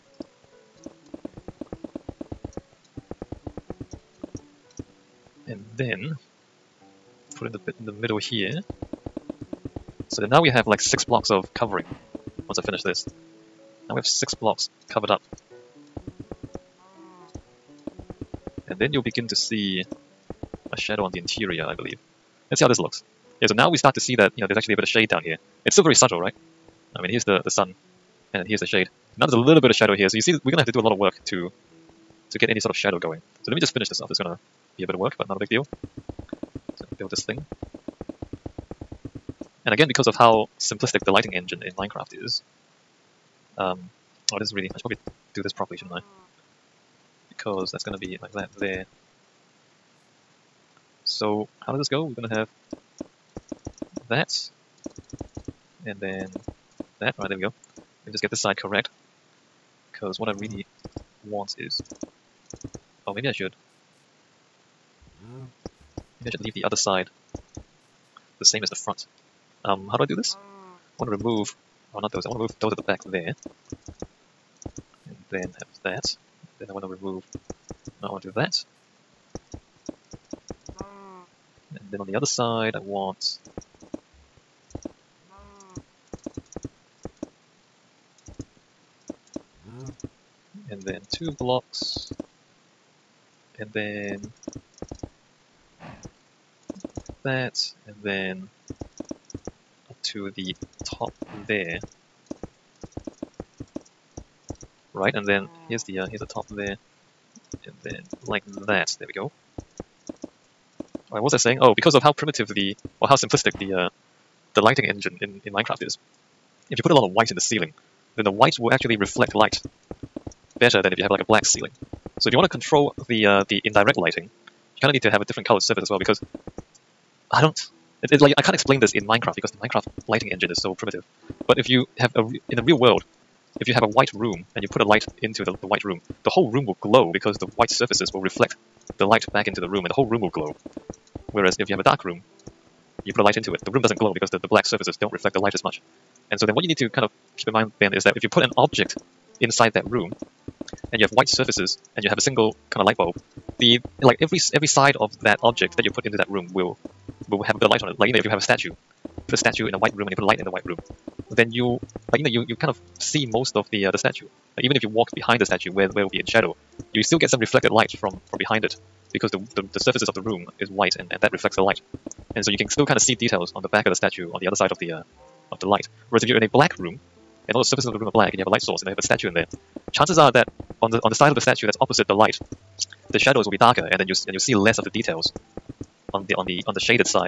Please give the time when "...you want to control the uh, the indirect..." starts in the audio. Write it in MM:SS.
02:02.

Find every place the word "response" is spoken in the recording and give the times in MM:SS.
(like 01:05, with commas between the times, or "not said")
not said.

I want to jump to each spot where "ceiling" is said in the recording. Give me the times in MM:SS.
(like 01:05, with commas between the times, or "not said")
01:57, 02:01.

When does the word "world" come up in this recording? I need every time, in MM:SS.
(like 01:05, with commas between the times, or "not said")
02:12.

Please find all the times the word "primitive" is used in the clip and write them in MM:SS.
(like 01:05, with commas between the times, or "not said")
01:52, 02:10.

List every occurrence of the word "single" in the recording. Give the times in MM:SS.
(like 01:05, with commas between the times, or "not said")
02:32.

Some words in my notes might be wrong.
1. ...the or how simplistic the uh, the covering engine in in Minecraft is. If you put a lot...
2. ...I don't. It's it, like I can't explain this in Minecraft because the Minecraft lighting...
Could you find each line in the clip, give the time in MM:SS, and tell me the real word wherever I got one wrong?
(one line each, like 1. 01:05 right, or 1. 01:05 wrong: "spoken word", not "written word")
1. 01:52 wrong: "lighting", not "covering"
2. 02:07 right.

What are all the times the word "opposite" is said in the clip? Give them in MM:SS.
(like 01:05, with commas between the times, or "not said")
03:01.